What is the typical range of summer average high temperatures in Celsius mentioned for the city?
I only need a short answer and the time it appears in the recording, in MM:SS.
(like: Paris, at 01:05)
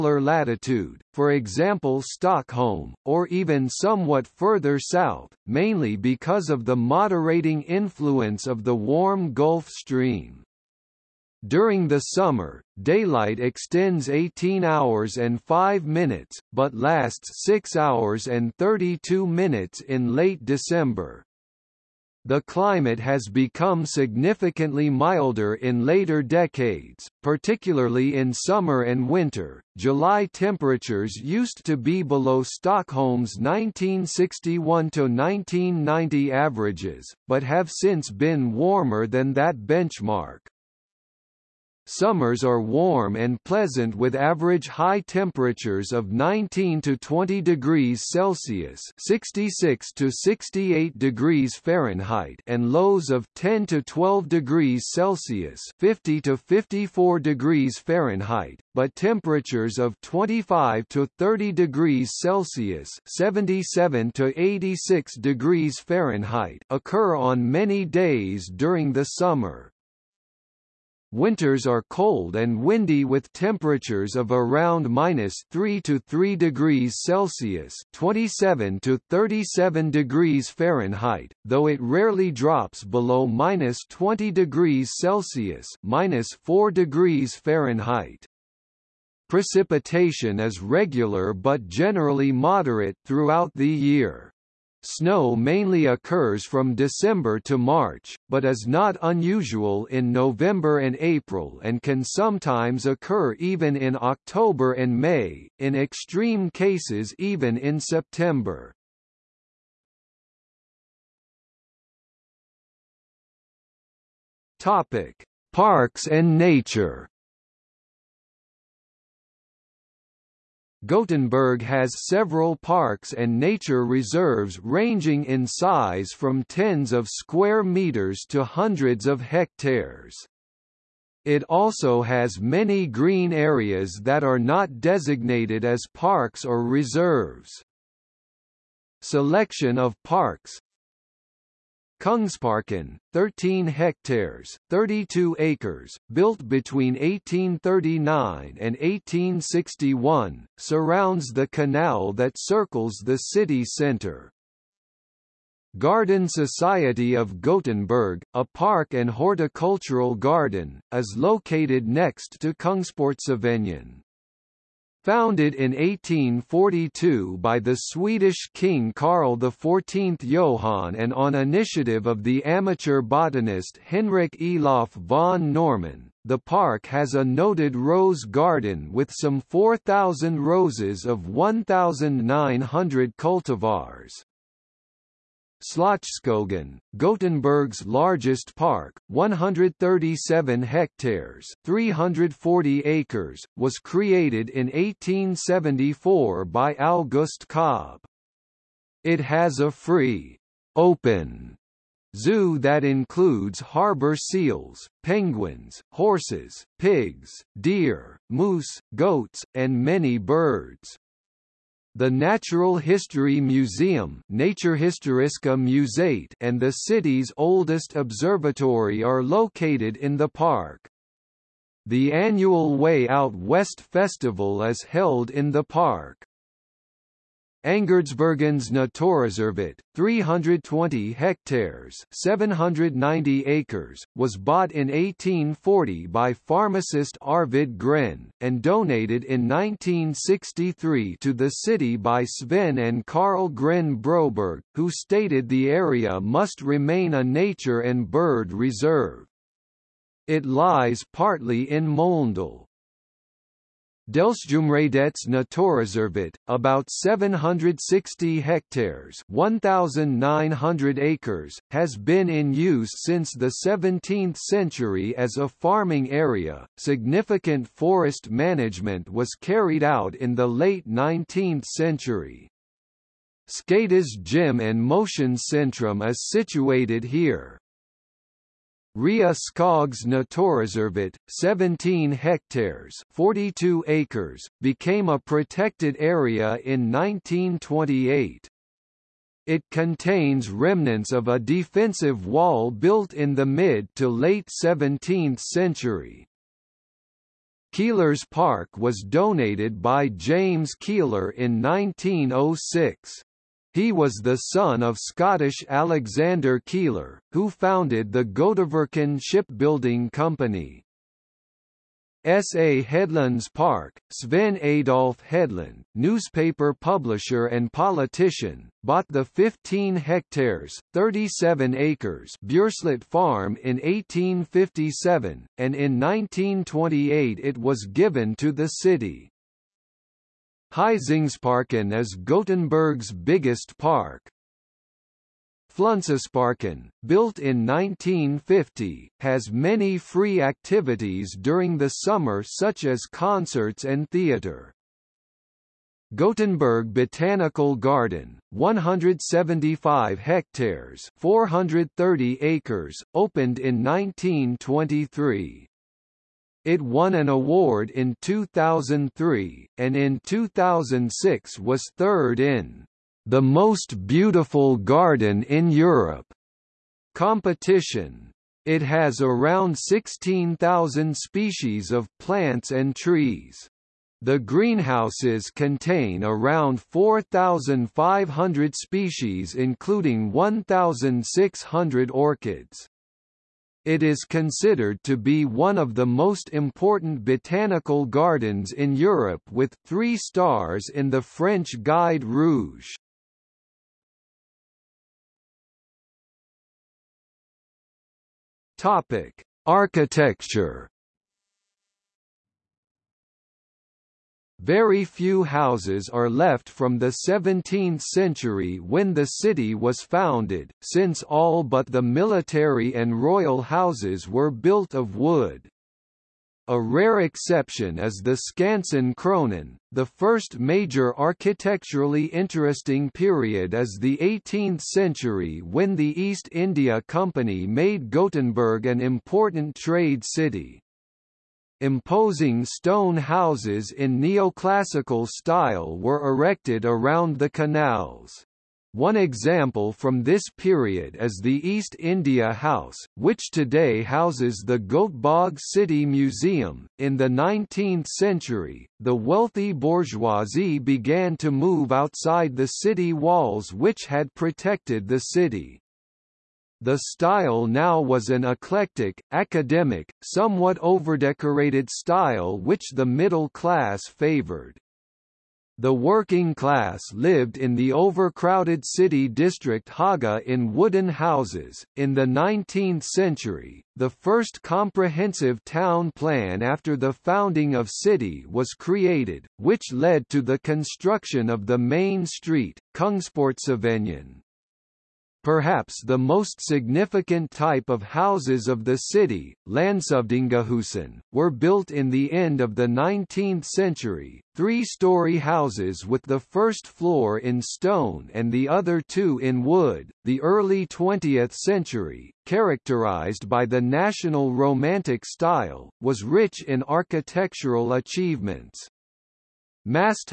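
19 to 20 degrees, at 00:46.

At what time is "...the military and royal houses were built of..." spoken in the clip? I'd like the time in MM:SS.
06:51.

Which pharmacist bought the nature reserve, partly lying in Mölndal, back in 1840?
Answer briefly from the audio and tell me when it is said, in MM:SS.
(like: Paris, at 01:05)
Arvid Gren, at 03:57.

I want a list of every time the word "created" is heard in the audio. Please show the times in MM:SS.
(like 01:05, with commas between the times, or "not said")
03:13, 07:58.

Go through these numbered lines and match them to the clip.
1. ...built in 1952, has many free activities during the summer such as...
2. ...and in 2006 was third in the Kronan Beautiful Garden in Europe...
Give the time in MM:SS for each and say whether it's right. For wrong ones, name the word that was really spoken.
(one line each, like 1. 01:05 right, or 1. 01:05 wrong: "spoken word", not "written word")
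1. 05:37 wrong: "1950", not "1952"
2. 05:59 wrong: "Most", not "Kronan".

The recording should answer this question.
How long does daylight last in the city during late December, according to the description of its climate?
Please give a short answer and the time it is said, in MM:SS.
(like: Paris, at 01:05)
6 hours and 32 minutes, at 00:17.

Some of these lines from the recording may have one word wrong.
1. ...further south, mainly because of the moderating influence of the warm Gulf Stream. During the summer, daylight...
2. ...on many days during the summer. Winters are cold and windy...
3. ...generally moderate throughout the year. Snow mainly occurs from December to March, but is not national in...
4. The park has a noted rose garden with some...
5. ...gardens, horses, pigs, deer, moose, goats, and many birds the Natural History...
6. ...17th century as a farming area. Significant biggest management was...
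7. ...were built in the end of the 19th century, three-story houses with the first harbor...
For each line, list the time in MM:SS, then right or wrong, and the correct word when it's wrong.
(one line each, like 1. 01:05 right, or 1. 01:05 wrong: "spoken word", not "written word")
1. 00:04 right
2. 01:07 right
3. 01:31 wrong: "unusual", not "national"
4. 02:56 right
5. 03:25 wrong: "penguins", not "gardens"
6. 04:23 wrong: "forest", not "biggest"
7. 08:11 wrong: "floor", not "harbor".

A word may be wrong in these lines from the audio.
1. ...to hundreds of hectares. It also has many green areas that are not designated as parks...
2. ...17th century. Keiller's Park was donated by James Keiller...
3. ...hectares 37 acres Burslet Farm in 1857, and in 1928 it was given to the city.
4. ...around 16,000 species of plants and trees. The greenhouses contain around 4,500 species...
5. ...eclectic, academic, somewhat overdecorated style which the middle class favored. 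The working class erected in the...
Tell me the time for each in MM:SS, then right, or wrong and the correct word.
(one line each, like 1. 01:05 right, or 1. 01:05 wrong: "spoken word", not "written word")
1. 02:08 right
2. 04:54 right
3. 05:19 right
4. 06:09 right
5. 07:38 wrong: "lived", not "erected".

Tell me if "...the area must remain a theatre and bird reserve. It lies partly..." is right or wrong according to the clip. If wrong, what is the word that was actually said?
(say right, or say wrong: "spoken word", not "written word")
wrong: "nature", not "theatre".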